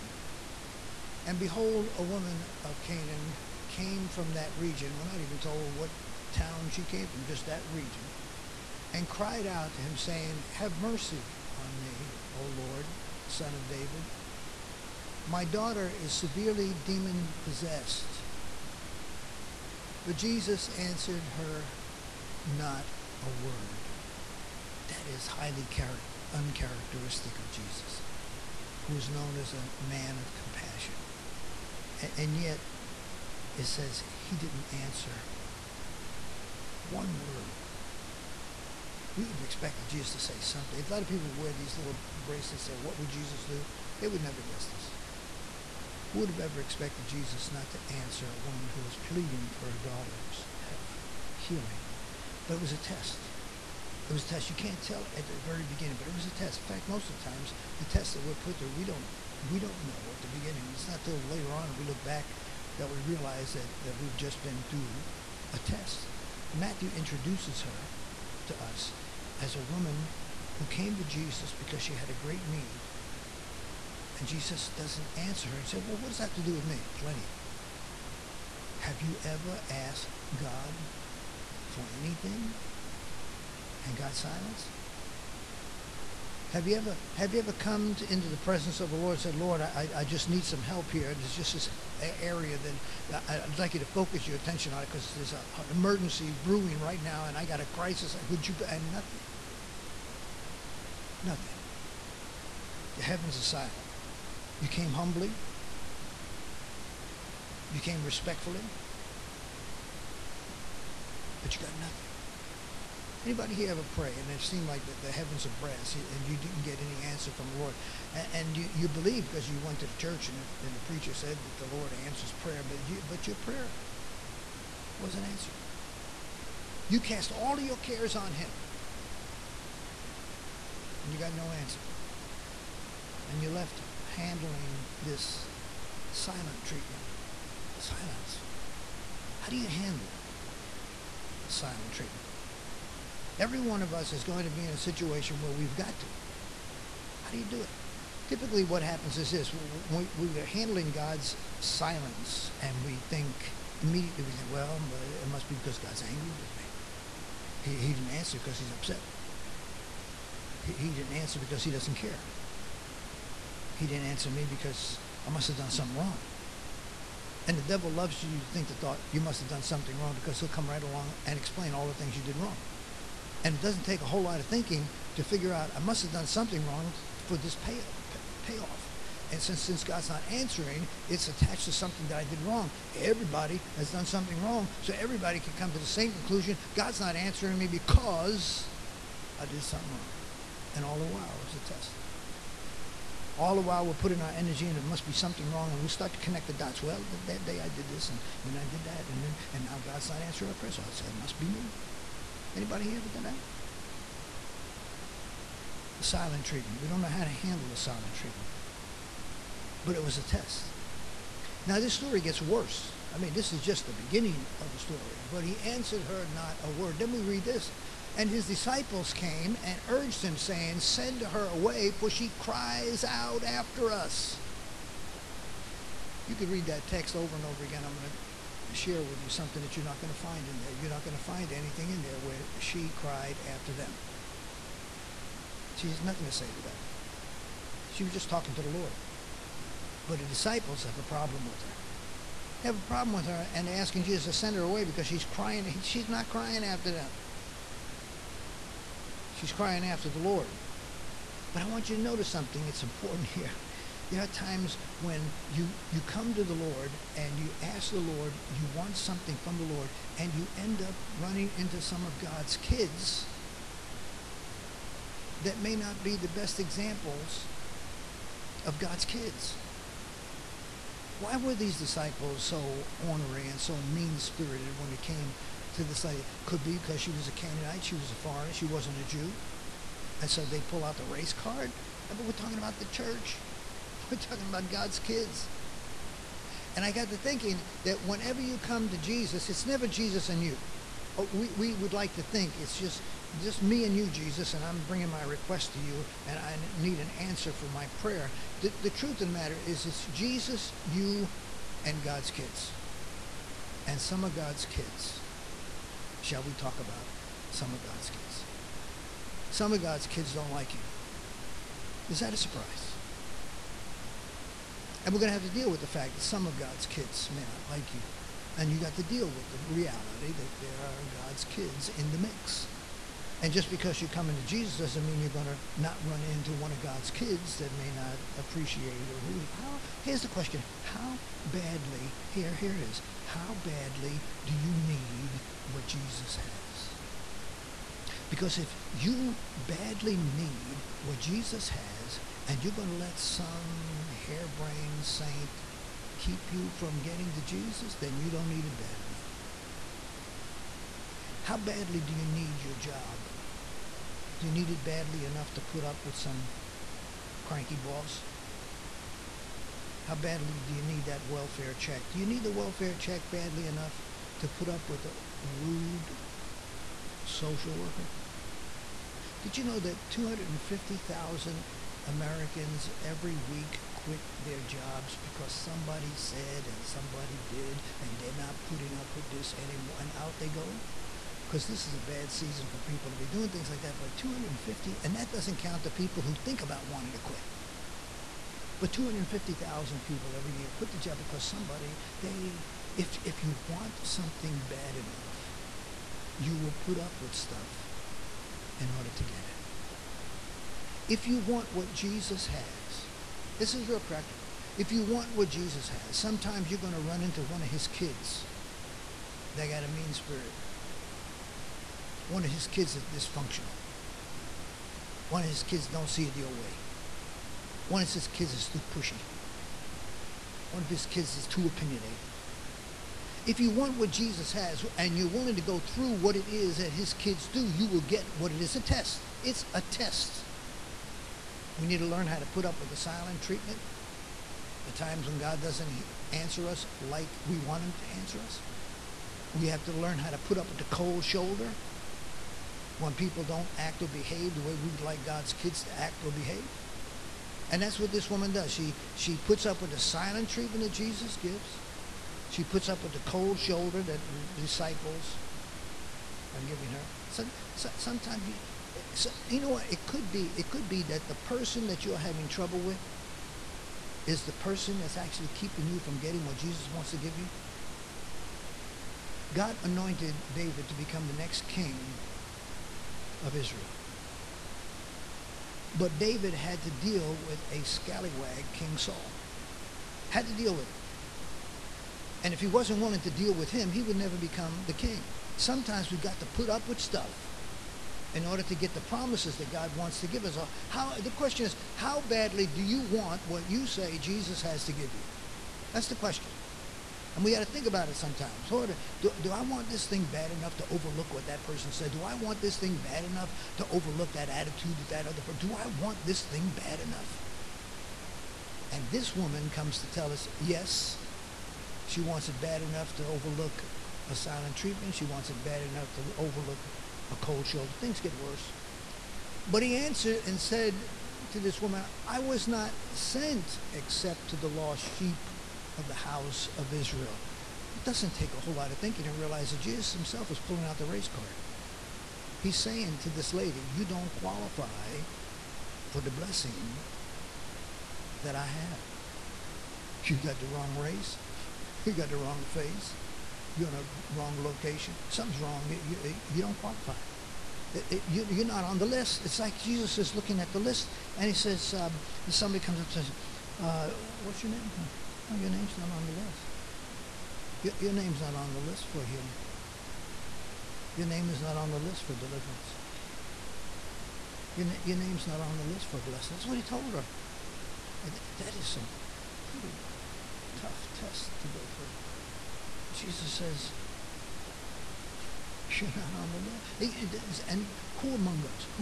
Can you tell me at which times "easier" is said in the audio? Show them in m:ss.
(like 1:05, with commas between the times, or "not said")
not said.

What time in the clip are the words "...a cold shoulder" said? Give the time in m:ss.
8:37.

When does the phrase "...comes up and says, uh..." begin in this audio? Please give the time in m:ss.
9:12.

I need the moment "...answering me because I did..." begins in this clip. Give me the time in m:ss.
3:07.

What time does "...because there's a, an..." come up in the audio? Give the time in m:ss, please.
1:34.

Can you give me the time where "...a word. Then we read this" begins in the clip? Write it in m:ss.
3:36.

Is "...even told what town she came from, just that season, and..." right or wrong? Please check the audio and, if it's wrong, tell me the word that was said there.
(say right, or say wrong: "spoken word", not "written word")
wrong: "region", not "season".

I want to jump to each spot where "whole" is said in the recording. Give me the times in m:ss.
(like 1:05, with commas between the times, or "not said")
2:54, 8:48.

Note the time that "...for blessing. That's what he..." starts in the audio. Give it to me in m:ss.
9:26.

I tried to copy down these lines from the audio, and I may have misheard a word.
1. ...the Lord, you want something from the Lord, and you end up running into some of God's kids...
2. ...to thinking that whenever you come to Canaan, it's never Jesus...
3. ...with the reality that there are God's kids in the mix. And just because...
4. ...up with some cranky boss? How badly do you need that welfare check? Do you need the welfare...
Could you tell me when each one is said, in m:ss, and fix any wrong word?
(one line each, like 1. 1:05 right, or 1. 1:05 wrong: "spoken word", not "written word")
1. 4:17 right
2. 4:47 wrong: "Jesus", not "Canaan"
3. 5:19 right
4. 5:55 right.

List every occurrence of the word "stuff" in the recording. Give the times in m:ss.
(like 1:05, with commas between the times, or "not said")
6:37, 8:07.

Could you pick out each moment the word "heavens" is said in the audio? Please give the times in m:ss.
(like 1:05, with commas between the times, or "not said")
1:43, 1:55.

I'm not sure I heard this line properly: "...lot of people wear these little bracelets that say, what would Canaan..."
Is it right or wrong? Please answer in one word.
wrong.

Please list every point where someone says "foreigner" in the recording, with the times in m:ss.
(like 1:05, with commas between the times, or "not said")
4:38.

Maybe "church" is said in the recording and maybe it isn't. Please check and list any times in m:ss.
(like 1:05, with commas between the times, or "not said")
1:59, 4:42.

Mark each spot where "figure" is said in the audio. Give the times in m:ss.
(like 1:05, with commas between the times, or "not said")
2:55.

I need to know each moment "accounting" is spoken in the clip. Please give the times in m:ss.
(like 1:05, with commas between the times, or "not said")
not said.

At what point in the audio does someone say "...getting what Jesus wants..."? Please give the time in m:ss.
7:46.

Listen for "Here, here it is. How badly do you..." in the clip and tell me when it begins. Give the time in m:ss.
5:32.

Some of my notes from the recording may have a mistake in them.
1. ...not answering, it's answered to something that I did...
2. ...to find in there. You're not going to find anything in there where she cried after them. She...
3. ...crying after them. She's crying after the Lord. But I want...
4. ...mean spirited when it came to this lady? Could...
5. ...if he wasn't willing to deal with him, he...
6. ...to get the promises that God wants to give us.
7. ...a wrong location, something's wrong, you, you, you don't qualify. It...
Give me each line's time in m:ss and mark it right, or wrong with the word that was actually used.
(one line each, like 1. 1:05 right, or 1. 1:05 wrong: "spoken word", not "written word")
1. 3:00 wrong: "attached", not "answered"
2. 3:50 right
3. 4:06 right
4. 4:33 right
5. 8:02 right
6. 8:08 right
7. 9:03 right.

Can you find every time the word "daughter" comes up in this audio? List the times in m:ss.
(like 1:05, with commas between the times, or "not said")
0:15, 0:49.